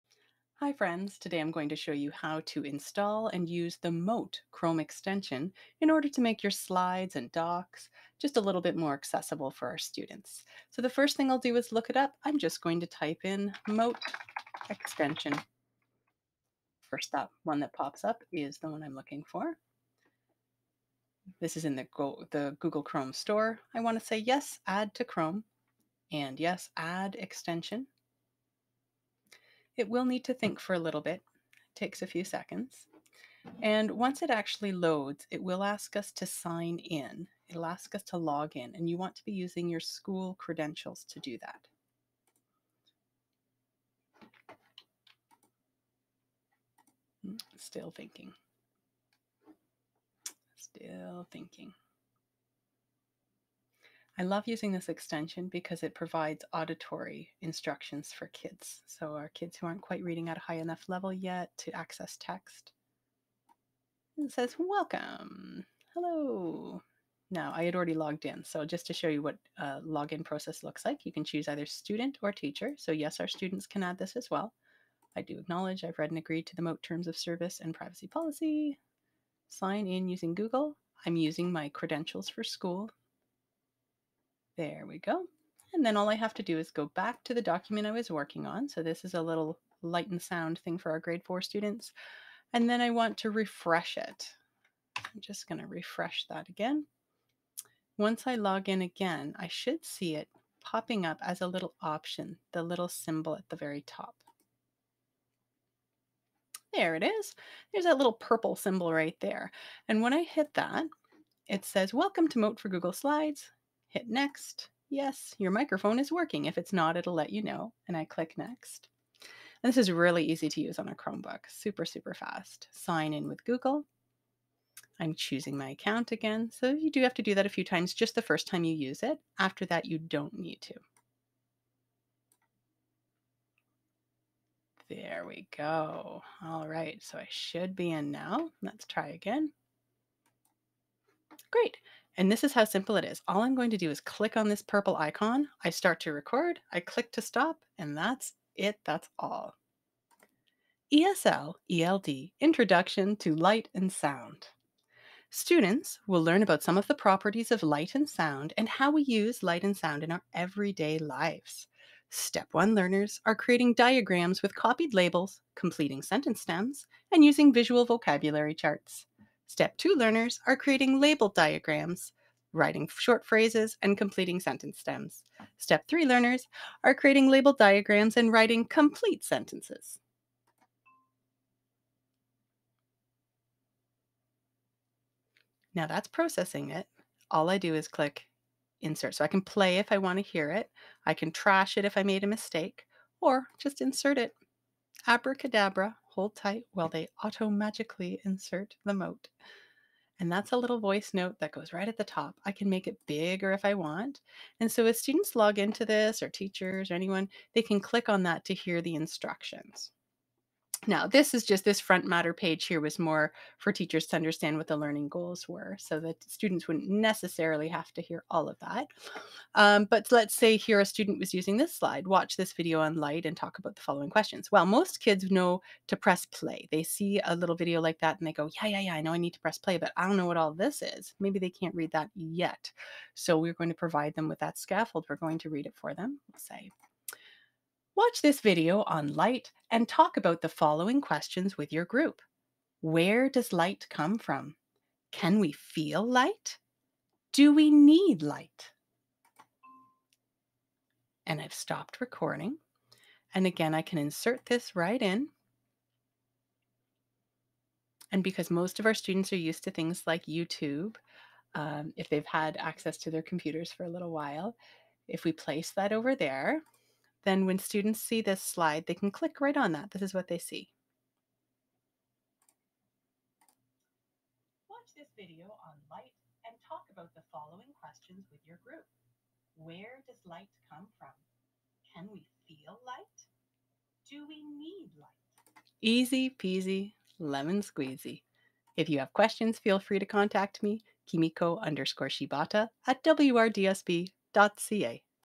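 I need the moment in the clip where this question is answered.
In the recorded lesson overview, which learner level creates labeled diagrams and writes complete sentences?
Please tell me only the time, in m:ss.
2:55.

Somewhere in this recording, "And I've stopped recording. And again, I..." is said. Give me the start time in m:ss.
4:11.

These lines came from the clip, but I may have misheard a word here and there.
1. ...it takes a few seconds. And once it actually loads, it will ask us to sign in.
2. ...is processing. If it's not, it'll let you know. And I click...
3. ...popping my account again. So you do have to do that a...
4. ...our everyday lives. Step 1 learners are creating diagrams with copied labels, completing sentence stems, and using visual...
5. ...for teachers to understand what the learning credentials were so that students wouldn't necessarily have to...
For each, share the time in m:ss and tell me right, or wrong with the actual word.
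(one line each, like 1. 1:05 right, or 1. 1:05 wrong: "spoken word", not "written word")
1. 0:31 right
2. 1:55 wrong: "working", not "processing"
3. 2:05 wrong: "choosing", not "popping"
4. 2:40 right
5. 3:33 wrong: "goals", not "credentials".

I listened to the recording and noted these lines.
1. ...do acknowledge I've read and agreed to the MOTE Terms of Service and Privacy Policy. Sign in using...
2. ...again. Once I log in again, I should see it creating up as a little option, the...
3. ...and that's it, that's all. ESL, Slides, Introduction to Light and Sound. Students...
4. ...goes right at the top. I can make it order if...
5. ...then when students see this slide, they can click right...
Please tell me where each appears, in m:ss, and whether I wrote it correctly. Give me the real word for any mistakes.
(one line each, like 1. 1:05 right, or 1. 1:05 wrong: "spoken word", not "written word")
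1. 1:15 right
2. 1:36 wrong: "popping", not "creating"
3. 2:27 wrong: "ELD", not "Slides"
4. 3:21 wrong: "bigger", not "order"
5. 4:27 right.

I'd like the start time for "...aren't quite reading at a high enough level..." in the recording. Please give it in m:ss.
0:59.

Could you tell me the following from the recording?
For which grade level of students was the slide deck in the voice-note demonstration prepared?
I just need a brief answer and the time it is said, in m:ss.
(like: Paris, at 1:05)
Grade 4, at 1:30.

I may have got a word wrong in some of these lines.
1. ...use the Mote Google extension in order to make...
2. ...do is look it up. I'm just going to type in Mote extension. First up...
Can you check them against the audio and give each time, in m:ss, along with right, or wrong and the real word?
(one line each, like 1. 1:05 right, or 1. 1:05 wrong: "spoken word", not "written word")
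1. 0:03 wrong: "Chrome", not "Google"
2. 0:11 right.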